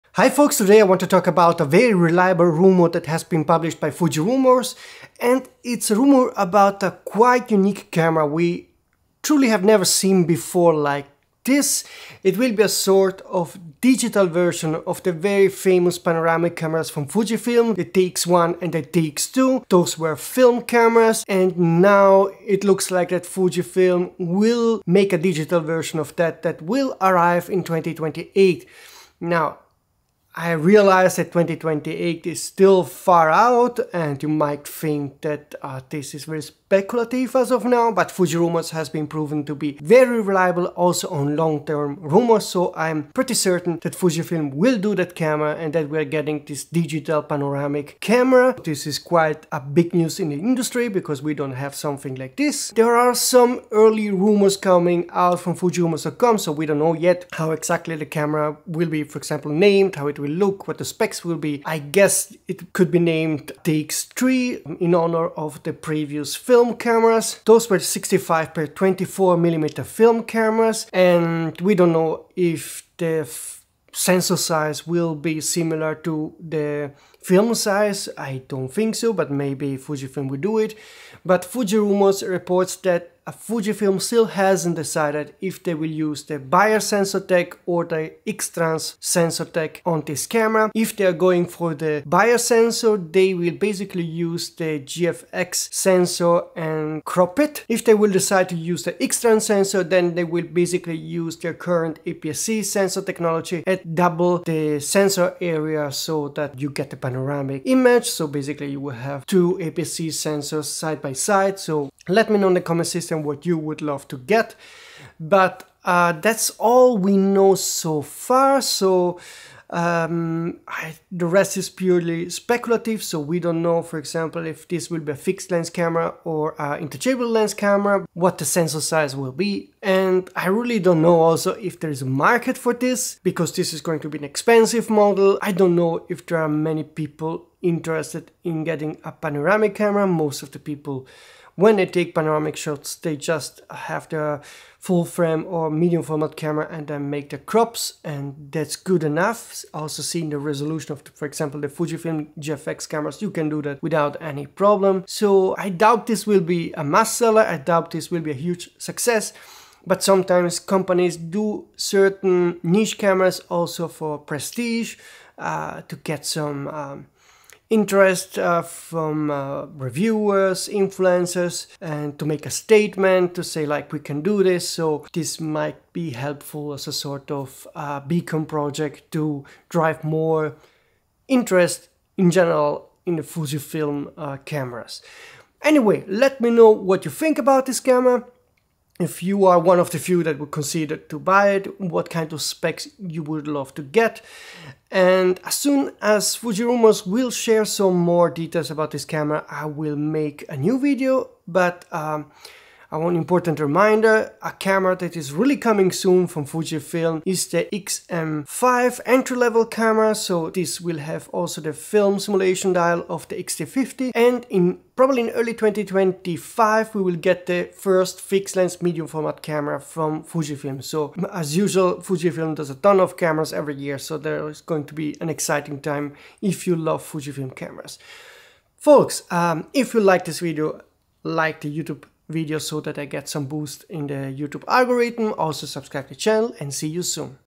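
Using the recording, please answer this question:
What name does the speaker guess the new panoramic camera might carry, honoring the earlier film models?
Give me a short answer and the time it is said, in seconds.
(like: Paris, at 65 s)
TX3, at 63 s.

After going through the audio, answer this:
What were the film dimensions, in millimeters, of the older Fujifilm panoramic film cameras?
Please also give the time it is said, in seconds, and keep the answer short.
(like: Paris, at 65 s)
65 x 24 mm, at 67 s.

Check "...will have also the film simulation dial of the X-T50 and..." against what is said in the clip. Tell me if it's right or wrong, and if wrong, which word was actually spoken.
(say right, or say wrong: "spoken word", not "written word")
right.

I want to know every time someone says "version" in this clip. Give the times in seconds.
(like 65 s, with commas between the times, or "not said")
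14 s, 25 s.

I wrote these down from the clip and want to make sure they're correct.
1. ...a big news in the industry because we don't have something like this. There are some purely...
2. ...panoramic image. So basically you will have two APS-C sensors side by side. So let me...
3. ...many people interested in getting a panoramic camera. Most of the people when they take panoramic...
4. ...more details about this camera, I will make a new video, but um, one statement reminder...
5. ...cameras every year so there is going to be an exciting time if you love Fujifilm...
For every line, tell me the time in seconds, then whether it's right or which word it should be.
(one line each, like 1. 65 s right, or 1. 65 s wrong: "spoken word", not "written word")
1. 49 s wrong: "early", not "purely"
2. 107 s right
3. 136 s right
4. 197 s wrong: "important", not "statement"
5. 223 s right.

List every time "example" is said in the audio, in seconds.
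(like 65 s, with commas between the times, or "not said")
59 s, 123 s, 151 s.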